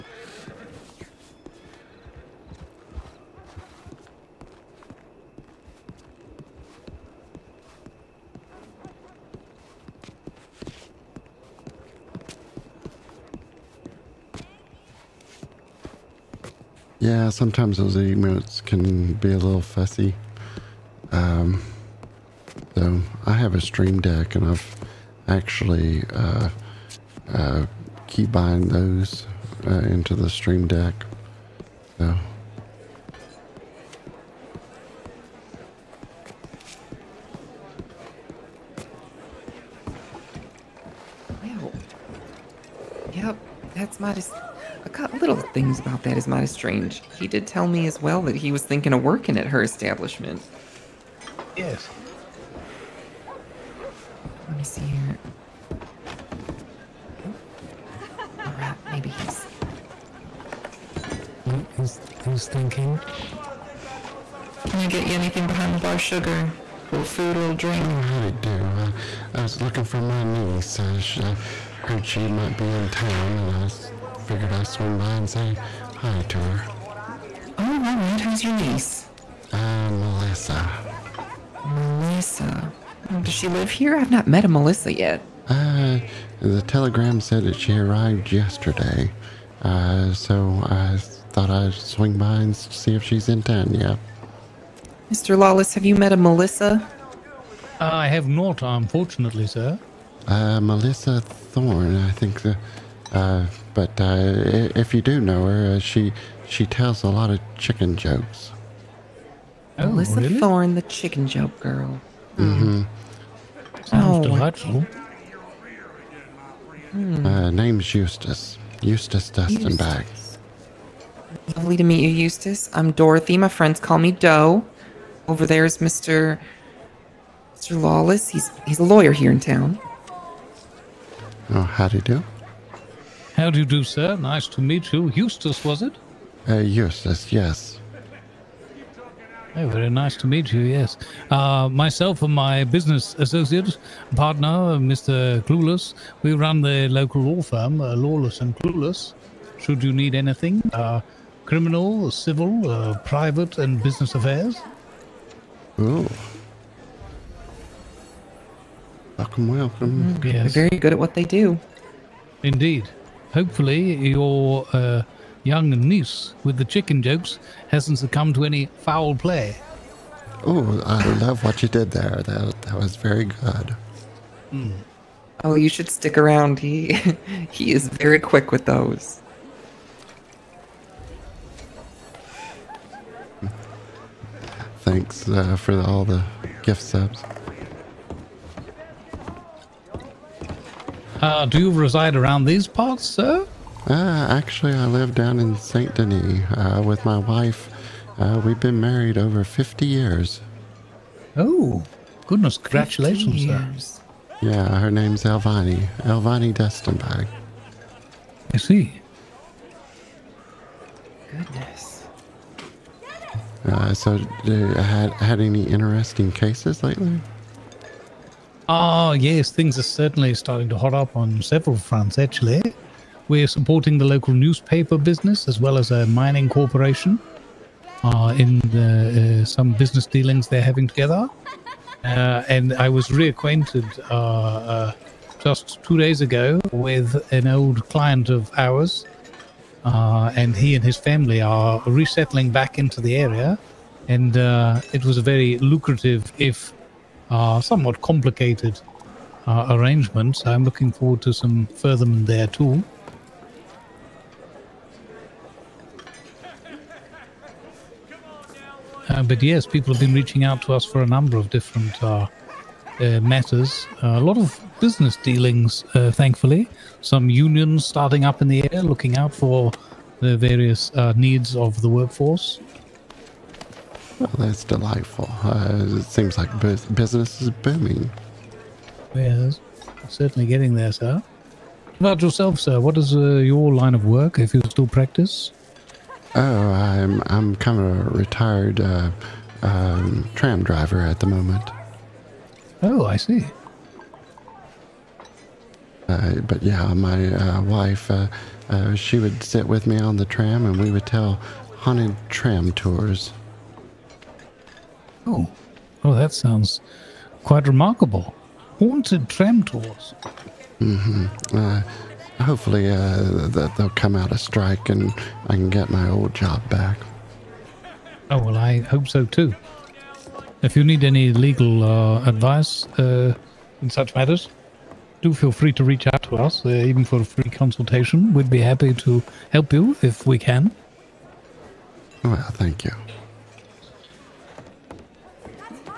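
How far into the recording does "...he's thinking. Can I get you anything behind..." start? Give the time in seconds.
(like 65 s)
62 s.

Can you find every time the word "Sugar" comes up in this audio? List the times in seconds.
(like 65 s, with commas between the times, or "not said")
65 s.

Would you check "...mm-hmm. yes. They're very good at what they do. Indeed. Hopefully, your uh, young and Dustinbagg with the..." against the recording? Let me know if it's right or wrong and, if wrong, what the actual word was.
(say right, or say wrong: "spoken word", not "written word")
wrong: "Noose", not "Dustinbagg".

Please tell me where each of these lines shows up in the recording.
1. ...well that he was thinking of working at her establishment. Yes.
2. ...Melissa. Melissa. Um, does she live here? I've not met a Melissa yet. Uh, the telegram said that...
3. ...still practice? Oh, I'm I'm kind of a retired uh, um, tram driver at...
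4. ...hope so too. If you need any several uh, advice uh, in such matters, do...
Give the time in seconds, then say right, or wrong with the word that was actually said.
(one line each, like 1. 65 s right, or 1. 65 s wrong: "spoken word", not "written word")
1. 48 s right
2. 79 s right
3. 284 s right
4. 318 s wrong: "legal", not "several".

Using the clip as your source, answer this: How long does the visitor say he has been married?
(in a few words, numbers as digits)
Over 50 years.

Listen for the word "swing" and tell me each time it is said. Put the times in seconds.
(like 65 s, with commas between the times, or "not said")
74 s, 91 s.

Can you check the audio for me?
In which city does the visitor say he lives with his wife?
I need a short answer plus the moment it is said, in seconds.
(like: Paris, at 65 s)
Saint Denis, at 195 s.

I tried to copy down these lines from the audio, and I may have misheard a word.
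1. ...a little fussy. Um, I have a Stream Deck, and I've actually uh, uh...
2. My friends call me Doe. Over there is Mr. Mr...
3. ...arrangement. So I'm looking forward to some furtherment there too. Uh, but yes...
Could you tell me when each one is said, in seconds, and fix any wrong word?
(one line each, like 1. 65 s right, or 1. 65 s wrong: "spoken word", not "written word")
1. 19 s right
2. 123 s right
3. 249 s right.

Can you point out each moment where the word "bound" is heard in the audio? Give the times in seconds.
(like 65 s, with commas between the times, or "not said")
not said.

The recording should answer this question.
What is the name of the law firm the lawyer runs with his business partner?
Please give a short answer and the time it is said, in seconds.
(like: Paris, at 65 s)
Lawless and Clueless, at 147 s.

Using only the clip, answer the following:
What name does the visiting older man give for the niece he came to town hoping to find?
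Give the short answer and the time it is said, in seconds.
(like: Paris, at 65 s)
Melissa Thorne, at 100 s.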